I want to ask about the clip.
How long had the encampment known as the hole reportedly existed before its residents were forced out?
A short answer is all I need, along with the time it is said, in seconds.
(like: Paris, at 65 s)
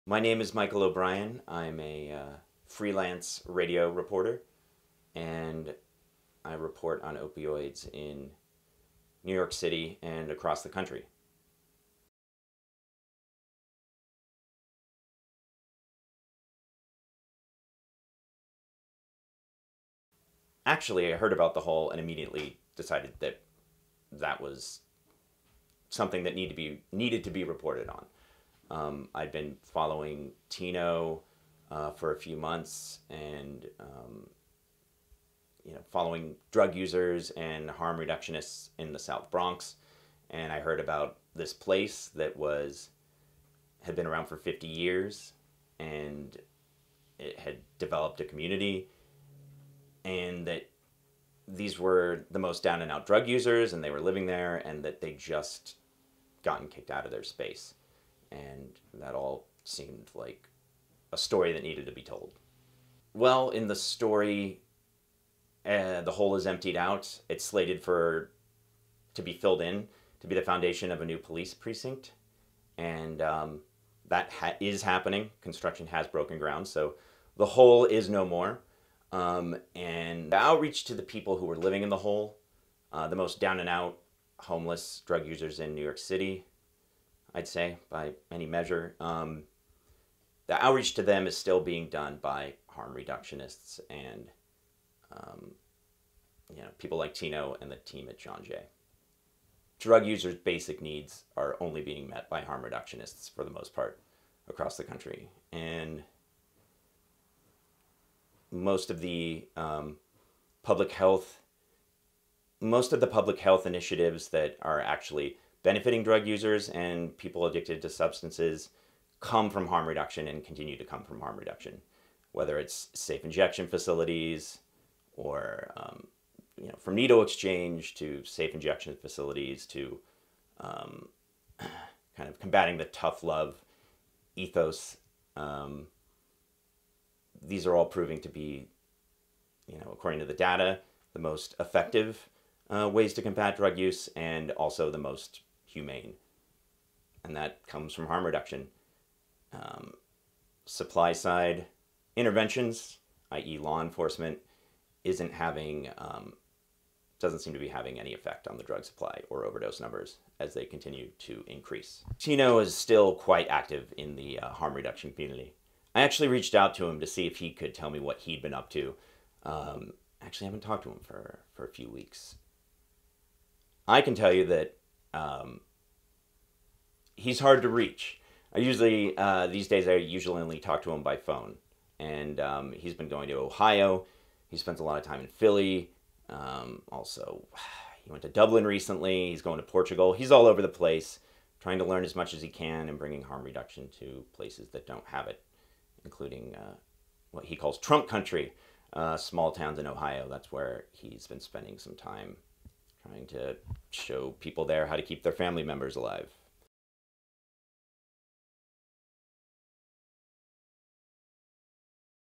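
50 years, at 44 s.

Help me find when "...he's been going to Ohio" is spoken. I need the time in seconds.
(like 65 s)
182 s.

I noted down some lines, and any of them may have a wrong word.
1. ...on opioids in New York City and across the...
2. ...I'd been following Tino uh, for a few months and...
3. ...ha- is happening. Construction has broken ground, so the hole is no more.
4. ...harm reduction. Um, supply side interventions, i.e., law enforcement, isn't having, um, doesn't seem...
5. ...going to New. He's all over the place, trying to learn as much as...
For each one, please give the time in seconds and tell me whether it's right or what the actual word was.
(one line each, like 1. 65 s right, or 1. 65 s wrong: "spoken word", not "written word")
1. 7 s right
2. 29 s right
3. 74 s right
4. 148 s right
5. 189 s wrong: "Portugal", not "New".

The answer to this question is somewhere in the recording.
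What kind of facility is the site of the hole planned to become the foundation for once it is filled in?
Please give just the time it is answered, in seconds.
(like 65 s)
71 s.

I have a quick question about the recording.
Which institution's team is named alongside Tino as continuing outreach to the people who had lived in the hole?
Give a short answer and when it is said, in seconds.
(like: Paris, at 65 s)
John Jay, at 98 s.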